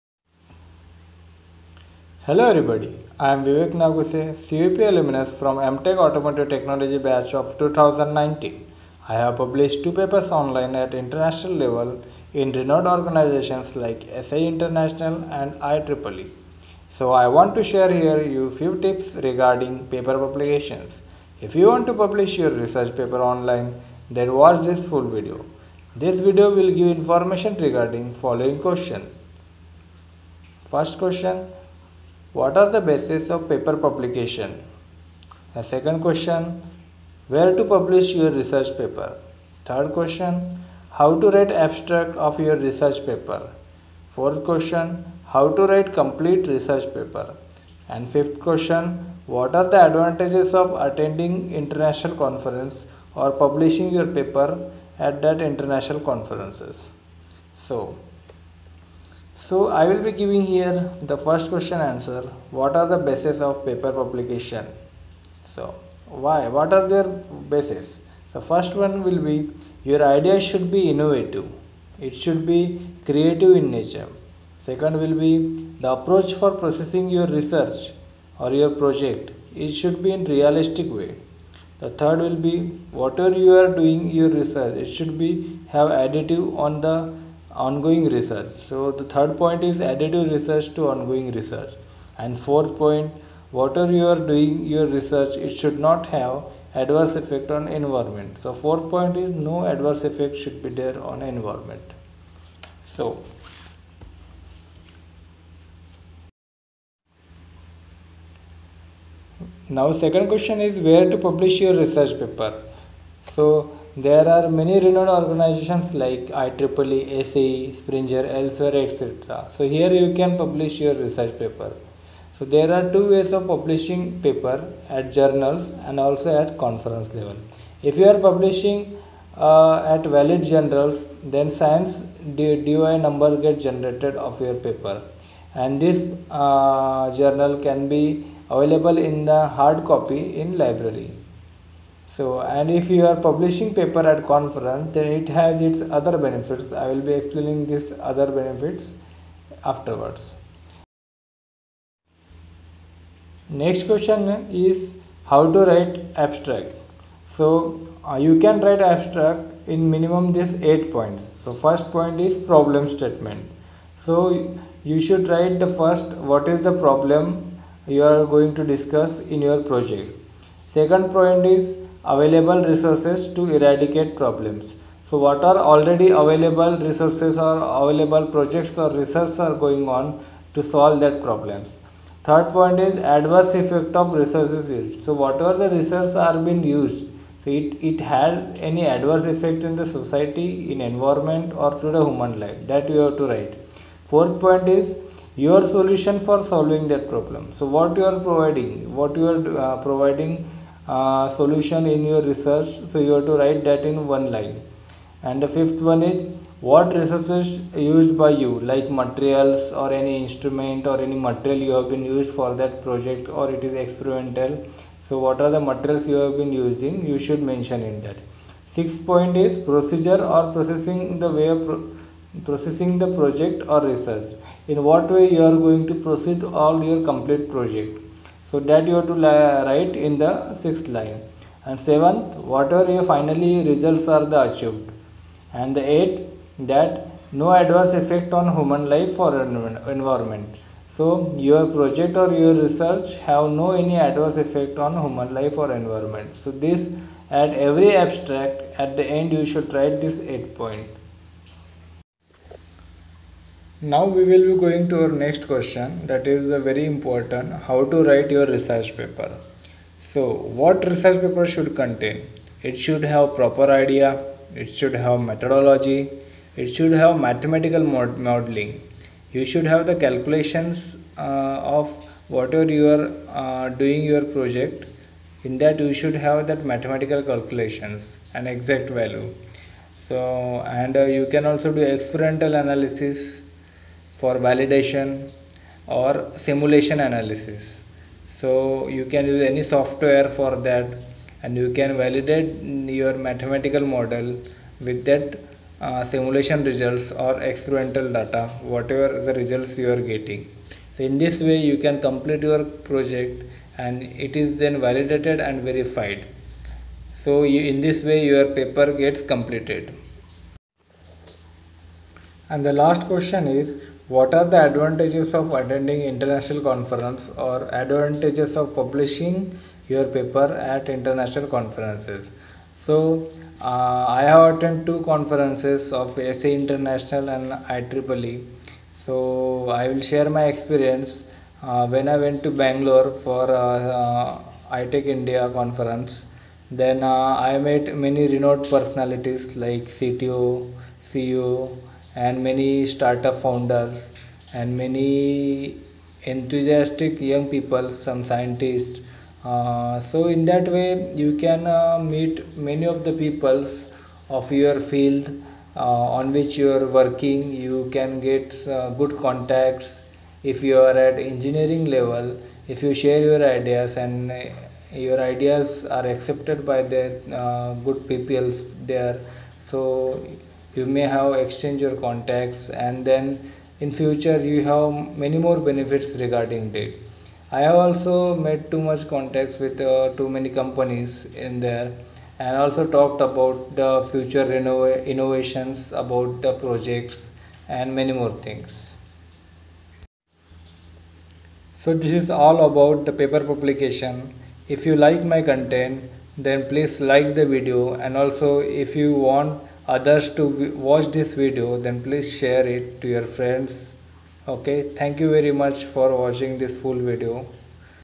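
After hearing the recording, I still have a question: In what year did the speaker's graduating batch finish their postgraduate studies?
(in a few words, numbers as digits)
2019.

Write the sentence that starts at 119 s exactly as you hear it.
So here you can publish your research paper.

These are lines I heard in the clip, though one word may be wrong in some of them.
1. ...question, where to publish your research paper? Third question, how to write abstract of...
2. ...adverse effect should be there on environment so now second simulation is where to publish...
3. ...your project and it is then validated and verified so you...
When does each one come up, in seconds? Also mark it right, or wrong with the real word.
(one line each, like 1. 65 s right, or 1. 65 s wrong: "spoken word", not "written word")
1. 35 s right
2. 99 s wrong: "question", not "simulation"
3. 302 s right.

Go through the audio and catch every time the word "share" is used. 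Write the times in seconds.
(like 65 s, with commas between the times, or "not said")
17 s, 330 s, 362 s, 402 s.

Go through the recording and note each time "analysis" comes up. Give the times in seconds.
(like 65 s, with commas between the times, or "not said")
282 s, 287 s.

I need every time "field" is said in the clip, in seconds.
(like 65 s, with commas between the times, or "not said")
354 s.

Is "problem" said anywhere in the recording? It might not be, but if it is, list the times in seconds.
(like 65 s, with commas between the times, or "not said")
162 s, 166 s, 174 s, 181 s, 197 s.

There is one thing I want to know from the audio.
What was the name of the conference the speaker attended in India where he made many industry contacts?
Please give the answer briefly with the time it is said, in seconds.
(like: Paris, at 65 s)
ITEC India, at 334 s.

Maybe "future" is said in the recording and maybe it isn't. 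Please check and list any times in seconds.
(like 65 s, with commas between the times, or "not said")
373 s, 384 s.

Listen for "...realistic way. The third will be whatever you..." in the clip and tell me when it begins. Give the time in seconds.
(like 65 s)
80 s.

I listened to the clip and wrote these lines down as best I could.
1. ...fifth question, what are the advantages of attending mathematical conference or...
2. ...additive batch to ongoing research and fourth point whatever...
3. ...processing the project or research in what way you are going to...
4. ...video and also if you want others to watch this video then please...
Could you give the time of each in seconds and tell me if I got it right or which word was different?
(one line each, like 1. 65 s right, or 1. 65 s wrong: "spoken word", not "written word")
1. 48 s wrong: "international", not "mathematical"
2. 89 s wrong: "research", not "batch"
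3. 222 s right
4. 397 s right.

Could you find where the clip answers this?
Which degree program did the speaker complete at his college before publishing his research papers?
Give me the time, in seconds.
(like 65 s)
5 s.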